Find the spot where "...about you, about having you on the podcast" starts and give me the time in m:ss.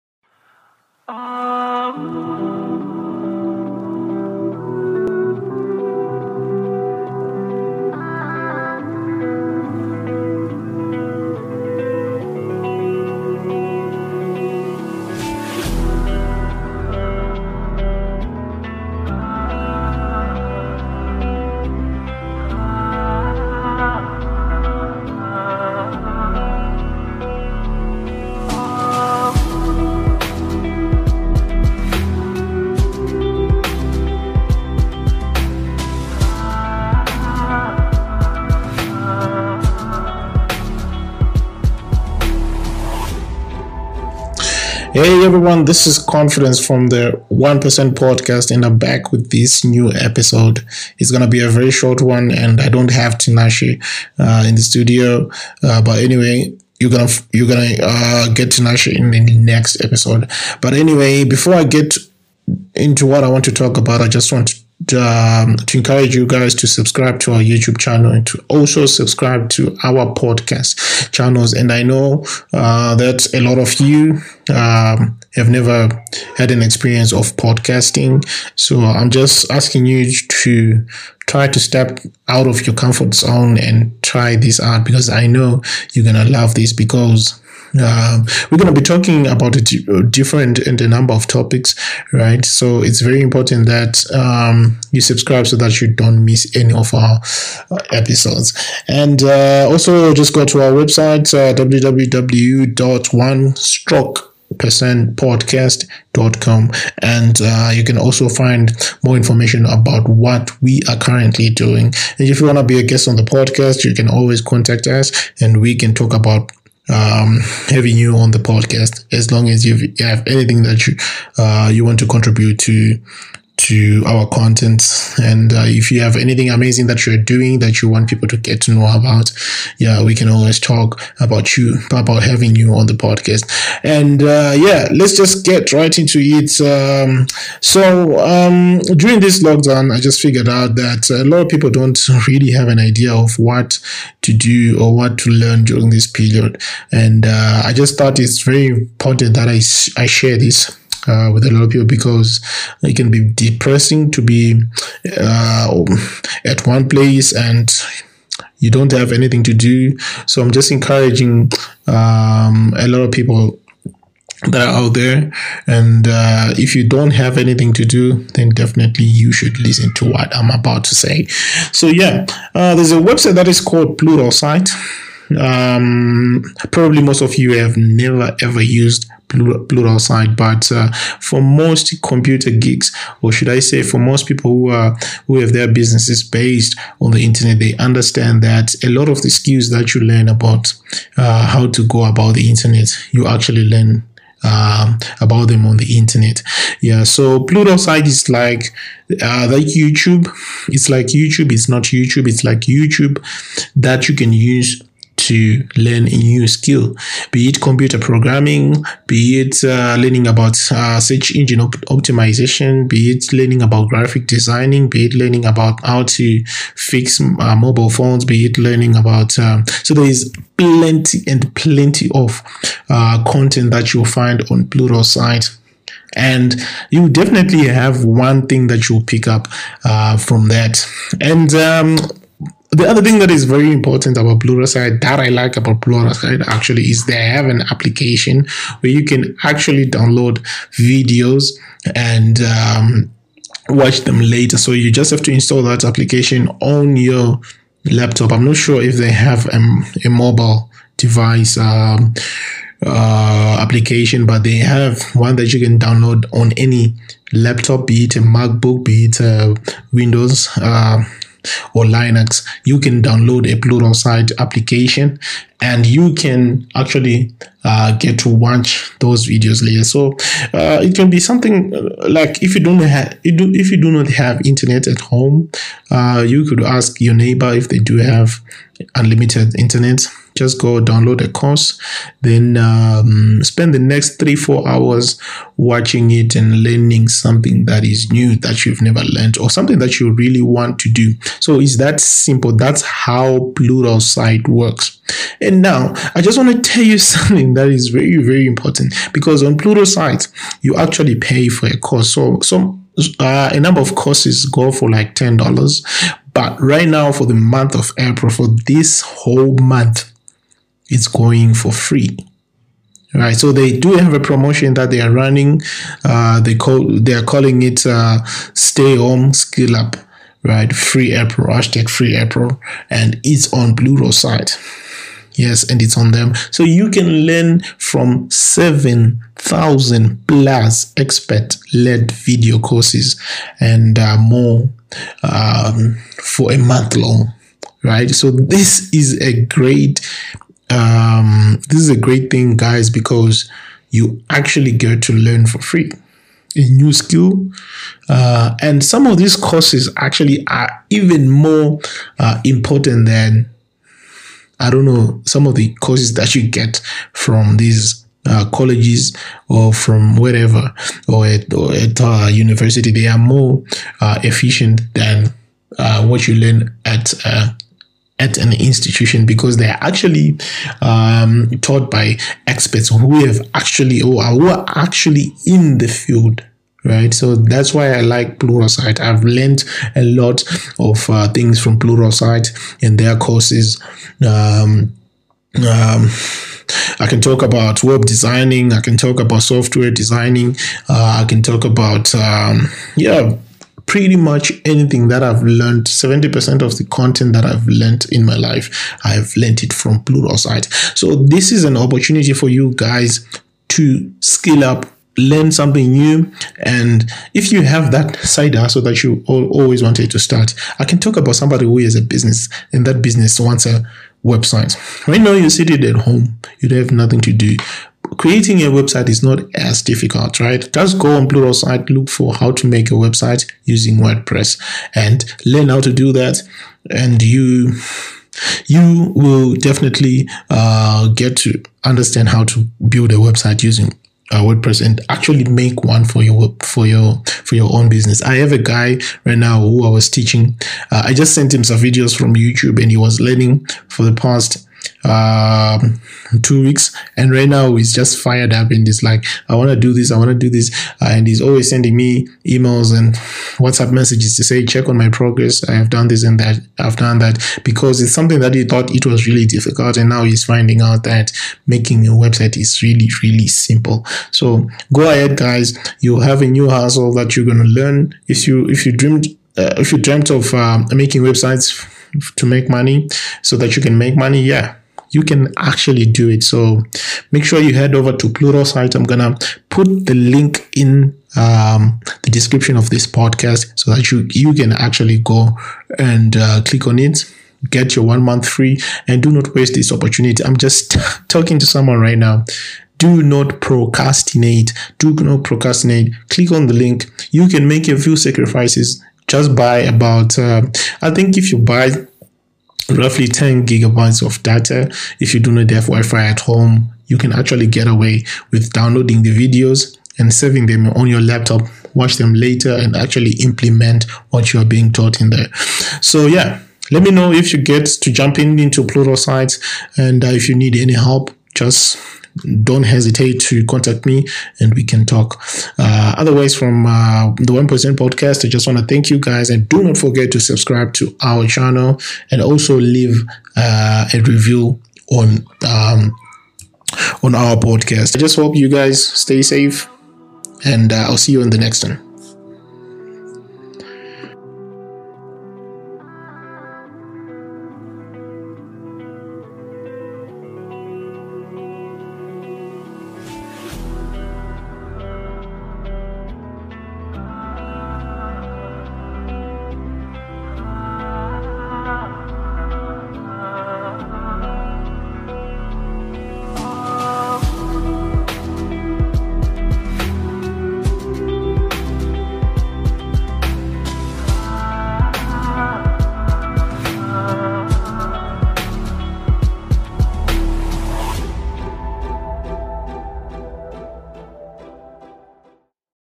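2:11.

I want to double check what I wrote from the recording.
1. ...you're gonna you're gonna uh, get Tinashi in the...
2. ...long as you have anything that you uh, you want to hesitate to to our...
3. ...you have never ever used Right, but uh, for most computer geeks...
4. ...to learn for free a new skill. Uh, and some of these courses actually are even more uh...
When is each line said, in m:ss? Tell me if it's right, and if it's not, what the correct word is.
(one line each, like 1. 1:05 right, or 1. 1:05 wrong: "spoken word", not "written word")
1. 0:56 right
2. 1:59 wrong: "contribute", not "hesitate"
3. 2:57 wrong: "Pluralsight", not "Right"
4. 5:45 right.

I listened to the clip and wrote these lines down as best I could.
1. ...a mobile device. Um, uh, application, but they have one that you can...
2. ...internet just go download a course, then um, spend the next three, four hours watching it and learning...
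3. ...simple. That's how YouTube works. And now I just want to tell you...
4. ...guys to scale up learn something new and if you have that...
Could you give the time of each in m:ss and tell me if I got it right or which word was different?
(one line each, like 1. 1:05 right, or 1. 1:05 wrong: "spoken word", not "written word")
1. 4:10 right
2. 4:39 right
3. 4:51 wrong: "Pluralsight", not "YouTube"
4. 6:42 right.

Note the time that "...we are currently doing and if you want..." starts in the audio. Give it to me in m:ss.
1:50.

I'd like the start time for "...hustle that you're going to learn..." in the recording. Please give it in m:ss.
7:46.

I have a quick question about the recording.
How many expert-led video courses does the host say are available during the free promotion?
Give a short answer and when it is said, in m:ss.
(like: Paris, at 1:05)
7,000 plus, at 5:28.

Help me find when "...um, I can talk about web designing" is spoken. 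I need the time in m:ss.
6:25.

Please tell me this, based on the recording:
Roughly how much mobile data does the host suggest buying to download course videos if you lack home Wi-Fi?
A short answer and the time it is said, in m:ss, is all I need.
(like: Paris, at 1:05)
10 gigabytes, at 8:23.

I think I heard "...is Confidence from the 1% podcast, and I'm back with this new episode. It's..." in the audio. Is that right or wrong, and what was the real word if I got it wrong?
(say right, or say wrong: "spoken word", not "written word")
right.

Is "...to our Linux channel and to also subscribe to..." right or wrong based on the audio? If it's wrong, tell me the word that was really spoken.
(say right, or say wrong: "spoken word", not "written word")
wrong: "YouTube", not "Linux".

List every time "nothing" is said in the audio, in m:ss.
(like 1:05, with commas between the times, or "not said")
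6:56.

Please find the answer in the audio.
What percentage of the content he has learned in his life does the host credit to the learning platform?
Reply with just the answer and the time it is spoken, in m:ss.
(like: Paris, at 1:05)
70%, at 6:35.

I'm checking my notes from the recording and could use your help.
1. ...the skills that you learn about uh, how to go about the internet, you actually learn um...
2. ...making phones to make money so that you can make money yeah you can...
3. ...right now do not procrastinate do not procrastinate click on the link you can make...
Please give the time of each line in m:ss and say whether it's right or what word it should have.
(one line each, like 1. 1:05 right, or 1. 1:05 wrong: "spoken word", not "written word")
1. 3:09 right
2. 7:50 wrong: "websites", not "phones"
3. 8:11 right.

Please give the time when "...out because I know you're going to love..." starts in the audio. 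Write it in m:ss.
1:24.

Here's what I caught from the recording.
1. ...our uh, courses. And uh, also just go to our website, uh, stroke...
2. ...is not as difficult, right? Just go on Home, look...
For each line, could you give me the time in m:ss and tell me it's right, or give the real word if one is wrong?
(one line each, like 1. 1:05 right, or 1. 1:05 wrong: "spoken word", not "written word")
1. 1:36 wrong: "episodes", not "courses"
2. 6:59 wrong: "Pluralsight", not "Home".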